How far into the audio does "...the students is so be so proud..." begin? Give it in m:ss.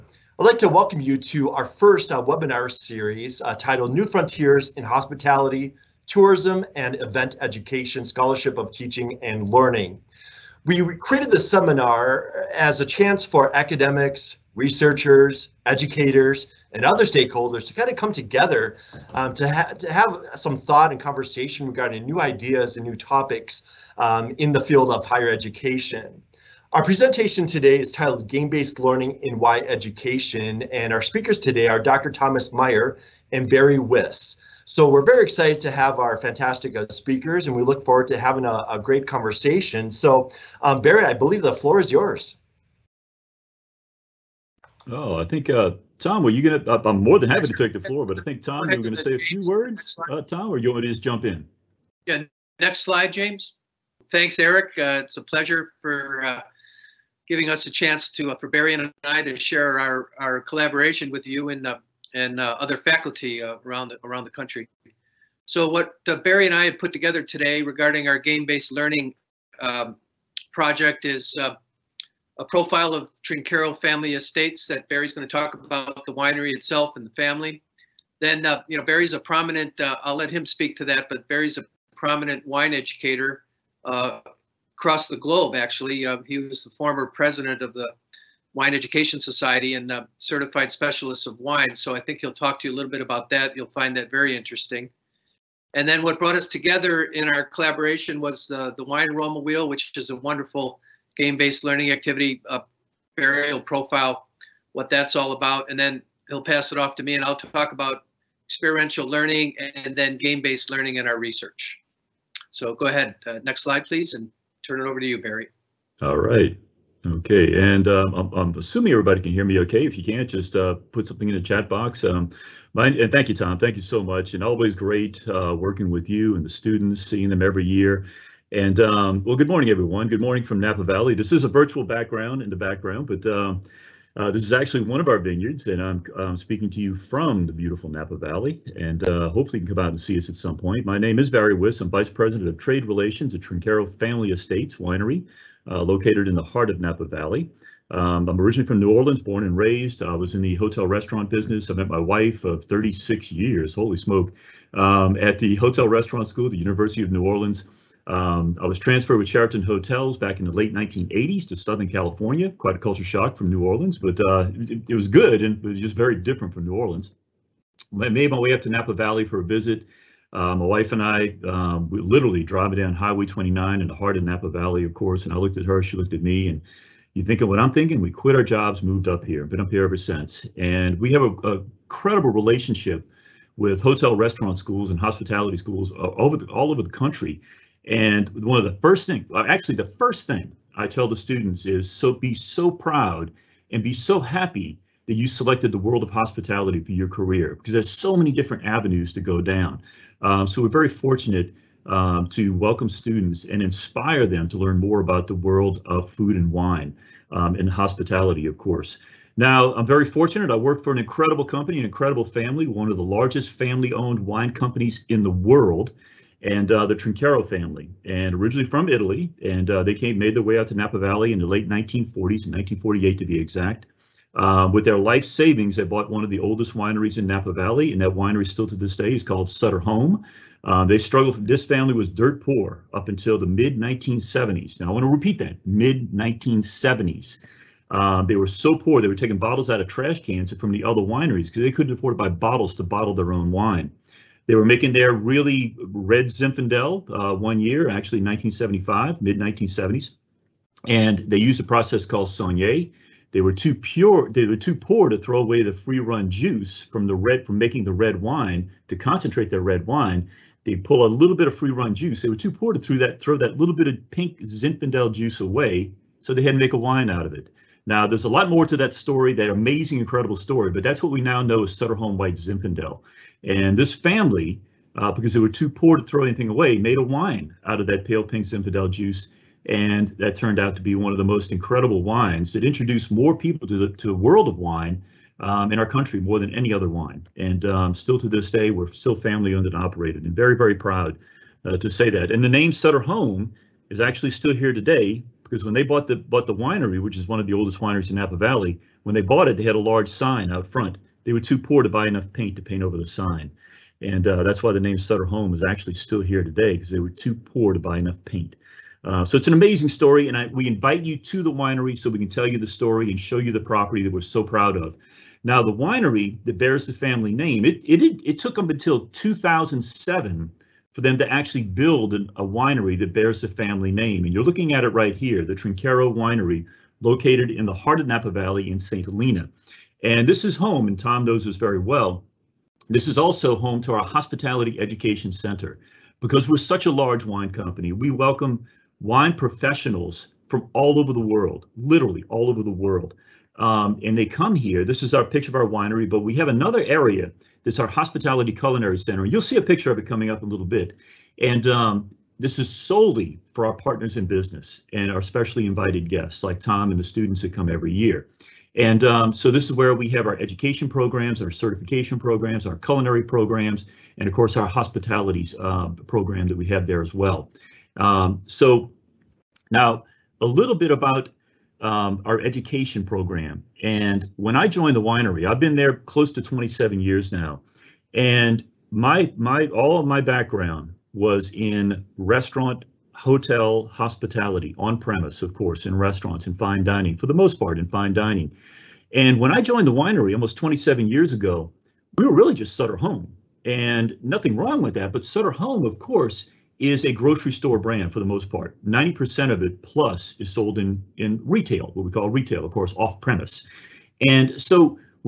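3:11.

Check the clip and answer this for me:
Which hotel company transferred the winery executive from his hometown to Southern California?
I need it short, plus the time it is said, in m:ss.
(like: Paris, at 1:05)
Sheraton Hotels, at 2:39.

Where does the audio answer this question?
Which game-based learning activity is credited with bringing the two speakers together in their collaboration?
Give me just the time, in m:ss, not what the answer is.
1:38.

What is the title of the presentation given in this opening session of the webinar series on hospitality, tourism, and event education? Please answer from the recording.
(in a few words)
Game-Based Learning in Wine Education.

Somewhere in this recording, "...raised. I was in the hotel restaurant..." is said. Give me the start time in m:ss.
2:29.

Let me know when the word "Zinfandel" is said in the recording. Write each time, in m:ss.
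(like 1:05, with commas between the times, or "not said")
4:06, 4:24, 4:32, 4:38.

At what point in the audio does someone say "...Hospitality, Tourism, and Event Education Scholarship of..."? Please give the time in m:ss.
0:04.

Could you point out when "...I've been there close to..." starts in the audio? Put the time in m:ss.
6:15.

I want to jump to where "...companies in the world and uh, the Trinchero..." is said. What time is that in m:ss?
3:34.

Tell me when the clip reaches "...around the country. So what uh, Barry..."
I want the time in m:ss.
1:04.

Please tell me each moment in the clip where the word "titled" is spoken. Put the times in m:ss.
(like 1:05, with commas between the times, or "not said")
0:03, 0:27.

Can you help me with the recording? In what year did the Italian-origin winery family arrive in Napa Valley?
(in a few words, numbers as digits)
1948.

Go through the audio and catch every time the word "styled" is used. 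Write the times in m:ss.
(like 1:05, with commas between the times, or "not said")
not said.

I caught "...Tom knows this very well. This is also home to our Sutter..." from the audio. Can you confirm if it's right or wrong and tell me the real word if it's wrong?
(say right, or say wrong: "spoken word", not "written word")
wrong: "Hospitality", not "Sutter".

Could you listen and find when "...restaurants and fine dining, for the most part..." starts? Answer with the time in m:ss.
6:25.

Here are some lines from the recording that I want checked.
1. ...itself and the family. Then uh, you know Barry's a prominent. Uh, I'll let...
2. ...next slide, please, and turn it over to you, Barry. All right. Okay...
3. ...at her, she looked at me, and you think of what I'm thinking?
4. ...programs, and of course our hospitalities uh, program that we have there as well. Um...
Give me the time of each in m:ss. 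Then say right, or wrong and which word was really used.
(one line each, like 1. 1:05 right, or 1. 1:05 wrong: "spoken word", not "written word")
1. 1:16 right
2. 1:53 right
3. 2:55 right
4. 6:03 right.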